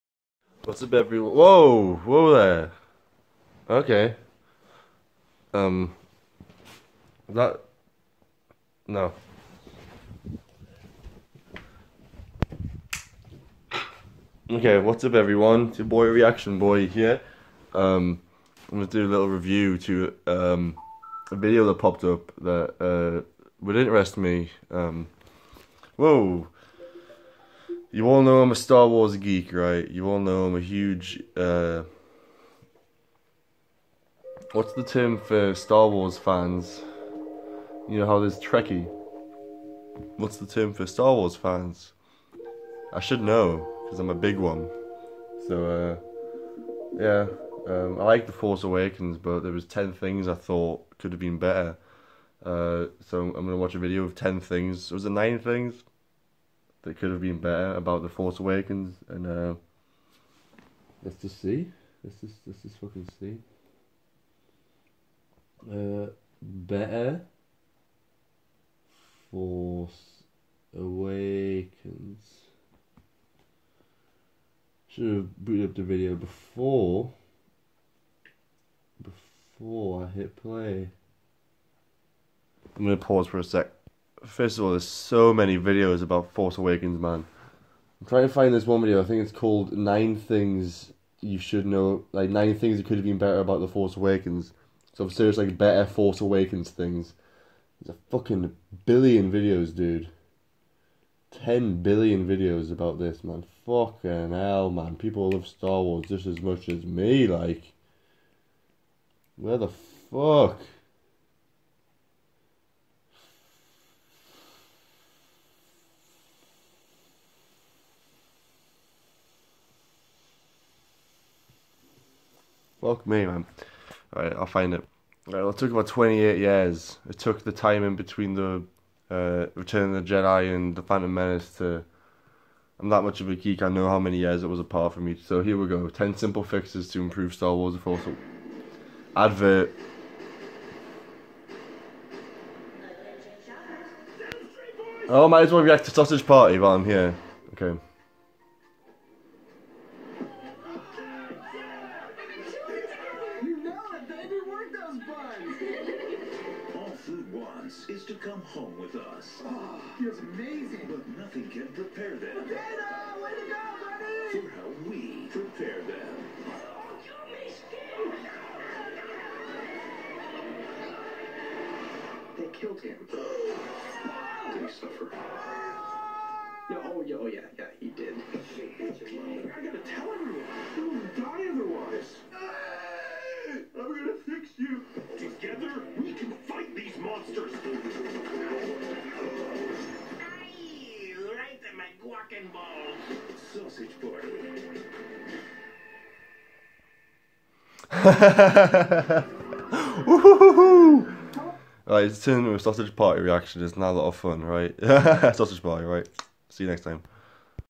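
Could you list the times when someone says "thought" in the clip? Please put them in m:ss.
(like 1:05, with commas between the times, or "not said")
0:50.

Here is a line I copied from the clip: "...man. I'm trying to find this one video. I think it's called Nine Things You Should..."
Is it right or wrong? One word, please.
right.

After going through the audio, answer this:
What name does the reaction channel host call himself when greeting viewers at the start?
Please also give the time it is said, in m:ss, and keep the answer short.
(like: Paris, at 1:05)
Reaction Boy, at 0:16.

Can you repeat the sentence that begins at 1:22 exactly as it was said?
I'm gonna pause for a sec.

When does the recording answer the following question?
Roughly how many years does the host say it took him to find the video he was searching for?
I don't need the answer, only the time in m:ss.
2:05.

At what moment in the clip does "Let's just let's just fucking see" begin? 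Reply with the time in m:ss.
1:02.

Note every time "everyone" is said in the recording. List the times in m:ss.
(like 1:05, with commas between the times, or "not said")
0:00, 0:15.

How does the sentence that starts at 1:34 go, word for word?
So, i like, better Force Awakens things.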